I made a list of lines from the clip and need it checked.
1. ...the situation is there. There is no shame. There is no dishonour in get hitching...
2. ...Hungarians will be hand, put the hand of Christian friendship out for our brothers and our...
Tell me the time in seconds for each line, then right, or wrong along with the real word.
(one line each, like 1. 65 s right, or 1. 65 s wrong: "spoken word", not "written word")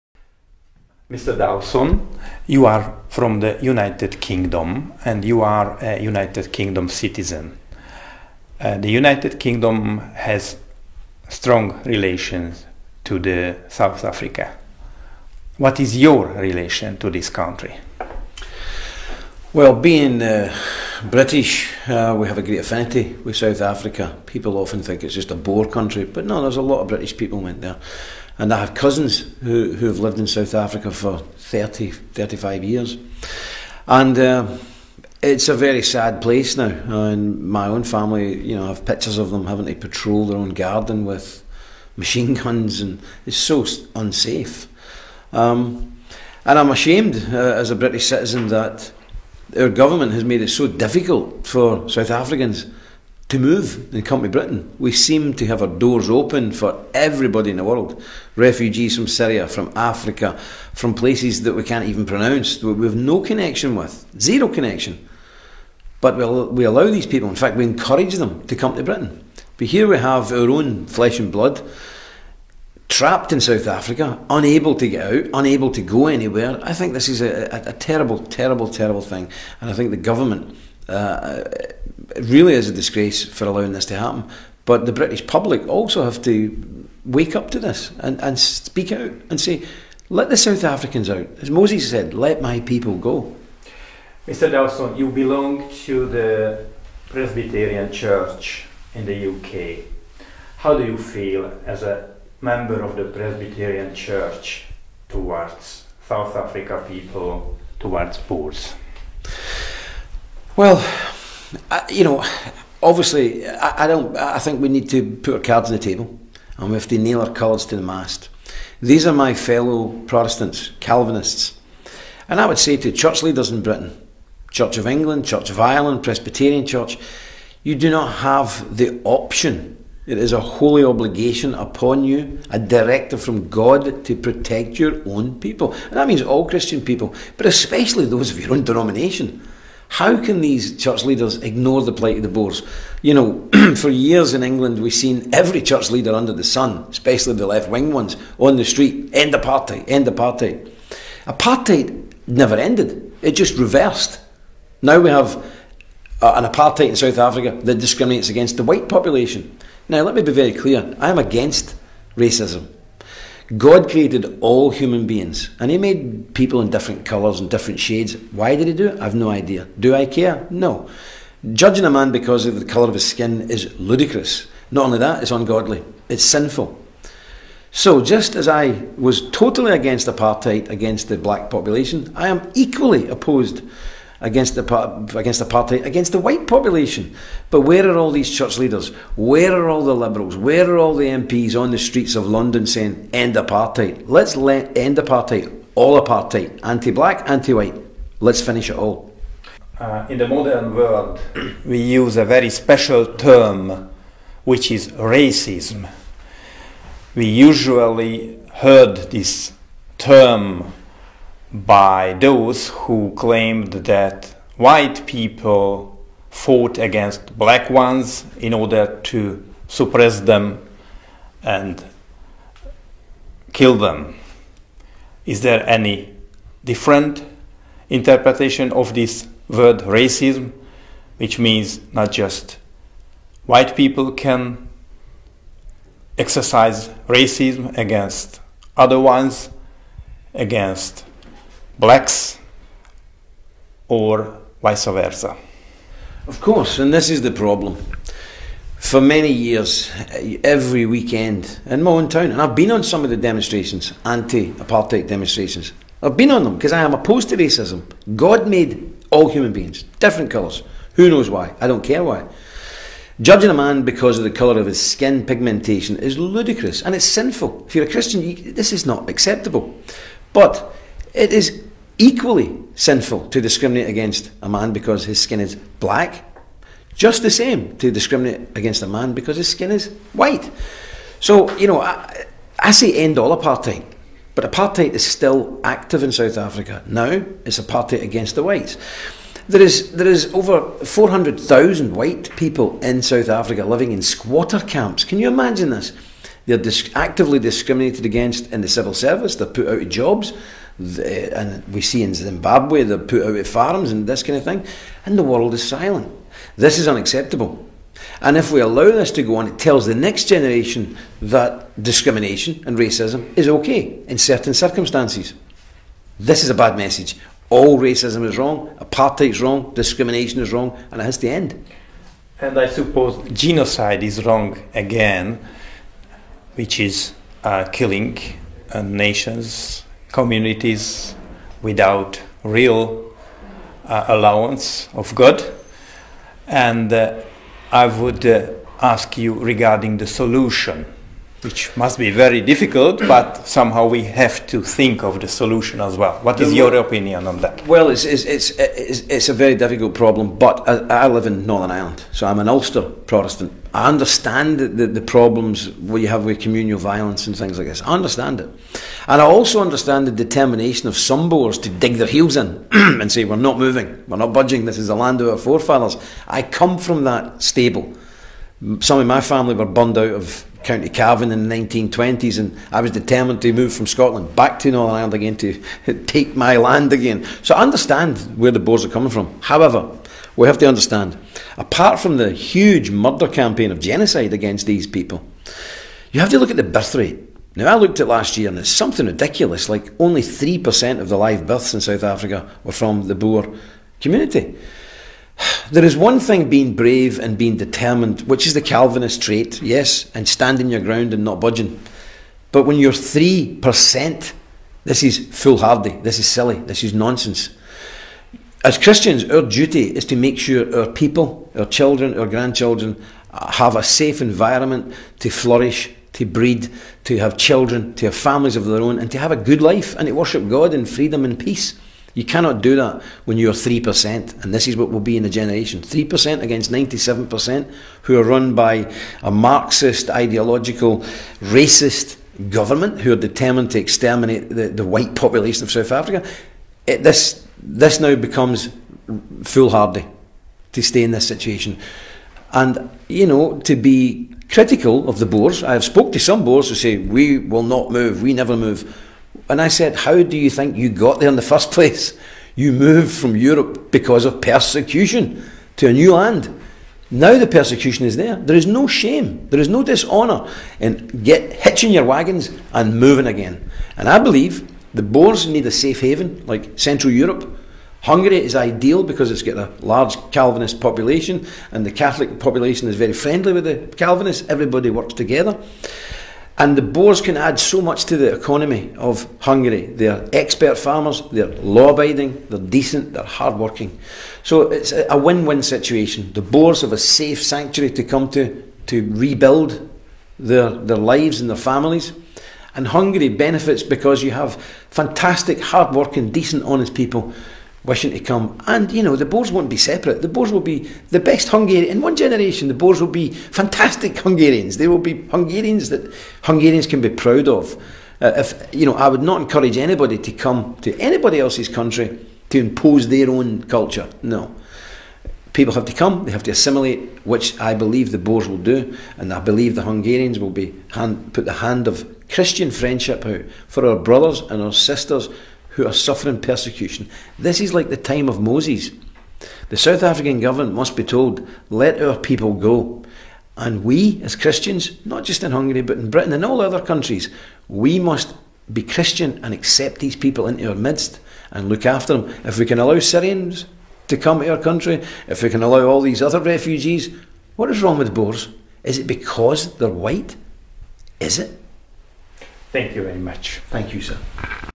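1. 457 s wrong: "persecution", not "situation"
2. 519 s right.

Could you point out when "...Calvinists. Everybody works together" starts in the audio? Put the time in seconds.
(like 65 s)
473 s.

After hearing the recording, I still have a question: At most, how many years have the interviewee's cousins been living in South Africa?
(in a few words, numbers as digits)
35.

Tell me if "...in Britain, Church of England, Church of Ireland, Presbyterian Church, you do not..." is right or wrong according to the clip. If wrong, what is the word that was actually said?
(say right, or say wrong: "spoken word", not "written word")
right.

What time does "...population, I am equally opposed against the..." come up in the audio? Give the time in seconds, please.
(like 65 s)
181 s.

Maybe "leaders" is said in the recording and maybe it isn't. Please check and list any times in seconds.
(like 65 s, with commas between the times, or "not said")
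123 s, 141 s, 145 s, 188 s.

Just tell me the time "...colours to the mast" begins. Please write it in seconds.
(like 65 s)
117 s.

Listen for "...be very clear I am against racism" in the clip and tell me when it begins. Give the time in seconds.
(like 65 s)
160 s.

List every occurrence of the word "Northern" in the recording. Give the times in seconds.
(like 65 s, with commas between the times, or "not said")
351 s, 374 s.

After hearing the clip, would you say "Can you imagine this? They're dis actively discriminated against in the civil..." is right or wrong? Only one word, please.
right.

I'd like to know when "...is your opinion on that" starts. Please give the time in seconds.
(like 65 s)
346 s.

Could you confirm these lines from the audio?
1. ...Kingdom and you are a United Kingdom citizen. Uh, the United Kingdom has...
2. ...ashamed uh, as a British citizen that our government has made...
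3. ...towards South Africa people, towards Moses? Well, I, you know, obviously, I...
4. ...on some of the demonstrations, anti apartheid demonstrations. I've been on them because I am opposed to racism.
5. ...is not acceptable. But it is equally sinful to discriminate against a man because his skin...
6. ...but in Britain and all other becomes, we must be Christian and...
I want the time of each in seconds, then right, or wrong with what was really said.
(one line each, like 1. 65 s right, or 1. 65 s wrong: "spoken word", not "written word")
1. 4 s right
2. 46 s right
3. 105 s wrong: "Boers", not "Moses"
4. 252 s right
5. 268 s right
6. 535 s wrong: "countries", not "becomes".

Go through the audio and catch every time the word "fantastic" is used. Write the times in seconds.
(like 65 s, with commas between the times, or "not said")
494 s, 503 s.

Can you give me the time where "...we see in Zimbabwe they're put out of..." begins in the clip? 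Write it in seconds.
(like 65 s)
301 s.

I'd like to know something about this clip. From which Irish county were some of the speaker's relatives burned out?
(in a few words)
County Cavan.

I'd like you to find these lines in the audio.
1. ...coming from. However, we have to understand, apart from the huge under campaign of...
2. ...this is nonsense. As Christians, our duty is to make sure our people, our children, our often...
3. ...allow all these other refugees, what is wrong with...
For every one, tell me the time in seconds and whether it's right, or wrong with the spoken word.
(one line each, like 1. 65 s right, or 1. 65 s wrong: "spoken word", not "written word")
1. 378 s wrong: "murder", not "under"
2. 406 s wrong: "grandchildren", not "often"
3. 545 s right.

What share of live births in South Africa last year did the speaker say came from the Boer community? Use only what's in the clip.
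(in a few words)
3%.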